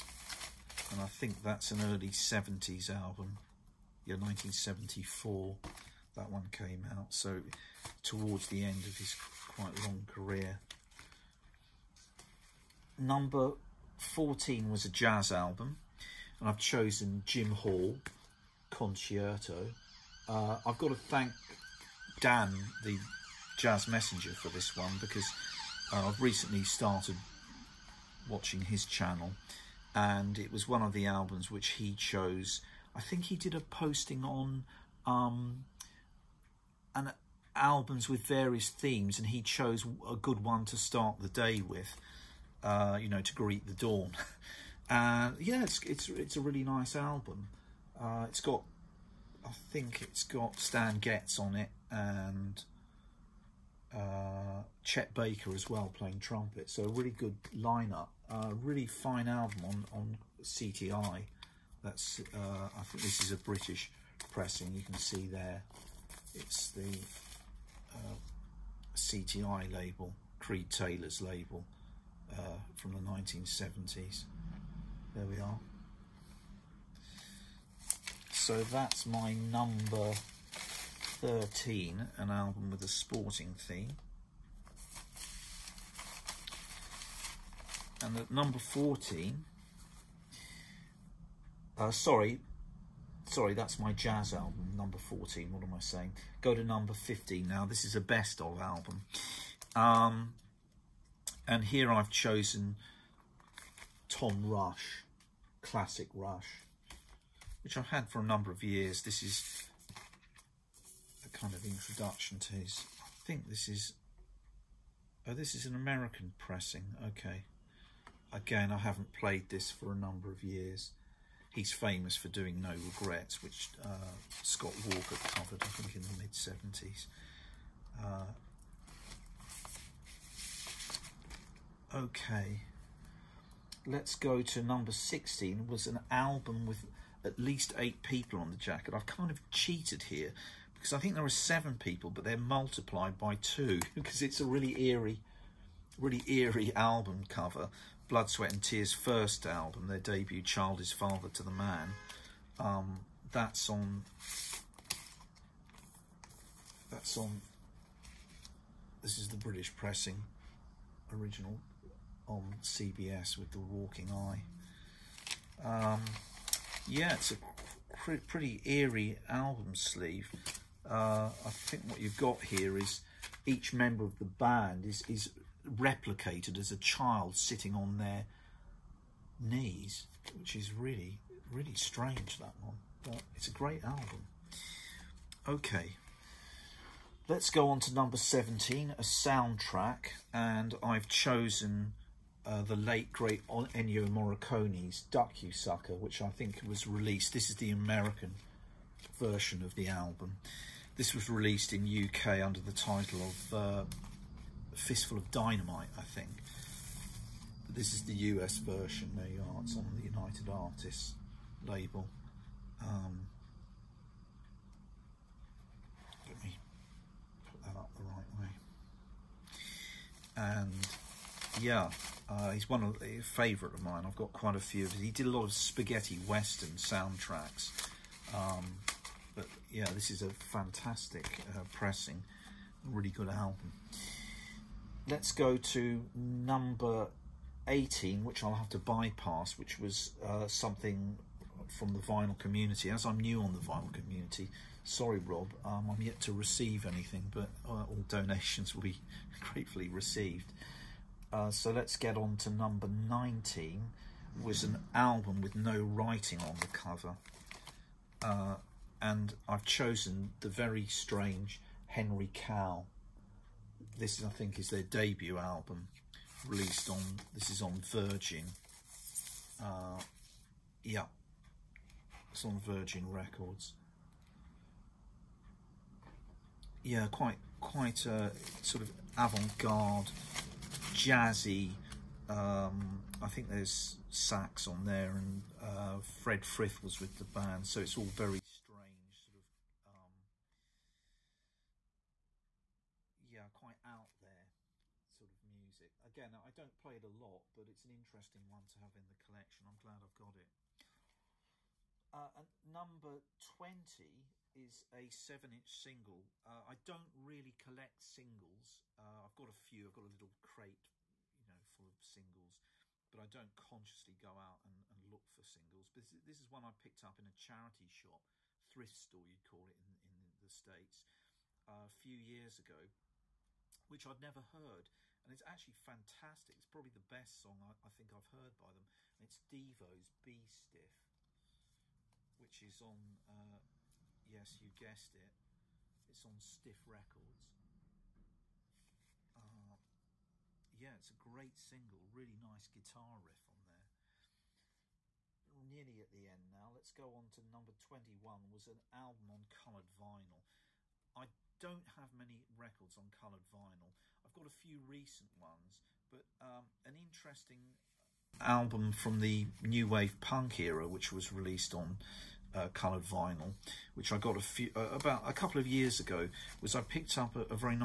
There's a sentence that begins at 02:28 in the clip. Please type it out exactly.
Blood, Sweat and Tears' first album, their debut, Child is Father to the Man.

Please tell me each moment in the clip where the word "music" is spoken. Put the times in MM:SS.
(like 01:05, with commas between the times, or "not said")
04:55.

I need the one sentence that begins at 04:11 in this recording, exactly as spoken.
Uh, so let's get on to number 19, was an album with no writing on the cover.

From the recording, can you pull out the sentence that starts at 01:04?
You can see there, it's the uh, CTI label, Creed Taylor's label uh, from the 1970s.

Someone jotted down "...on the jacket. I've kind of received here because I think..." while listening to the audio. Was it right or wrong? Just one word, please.
wrong.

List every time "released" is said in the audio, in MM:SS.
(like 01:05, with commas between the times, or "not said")
03:16, 03:21, 04:26, 06:01.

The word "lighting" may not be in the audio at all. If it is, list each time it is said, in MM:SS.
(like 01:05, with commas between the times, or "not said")
not said.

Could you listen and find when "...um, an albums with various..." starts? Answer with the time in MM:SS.
00:35.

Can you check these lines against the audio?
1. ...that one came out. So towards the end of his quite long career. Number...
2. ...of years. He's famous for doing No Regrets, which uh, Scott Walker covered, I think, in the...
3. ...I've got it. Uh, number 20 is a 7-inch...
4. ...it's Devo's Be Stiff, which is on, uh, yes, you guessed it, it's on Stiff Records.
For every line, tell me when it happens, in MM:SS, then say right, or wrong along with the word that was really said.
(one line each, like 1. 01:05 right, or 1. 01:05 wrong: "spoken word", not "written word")
1. 00:06 right
2. 02:00 right
3. 05:00 right
4. 05:29 right.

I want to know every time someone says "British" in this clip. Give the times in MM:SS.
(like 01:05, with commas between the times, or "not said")
01:03, 02:39.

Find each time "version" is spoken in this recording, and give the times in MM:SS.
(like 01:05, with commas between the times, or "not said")
03:19, 03:28.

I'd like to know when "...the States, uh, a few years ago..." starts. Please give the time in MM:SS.
05:20.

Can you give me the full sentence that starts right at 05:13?
But I don't consciously go out and, and look for singles.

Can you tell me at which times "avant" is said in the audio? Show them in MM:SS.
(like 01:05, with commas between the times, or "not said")
04:39.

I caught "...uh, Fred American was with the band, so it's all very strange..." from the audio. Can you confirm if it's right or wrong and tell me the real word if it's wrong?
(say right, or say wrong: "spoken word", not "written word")
wrong: "Frith", not "American".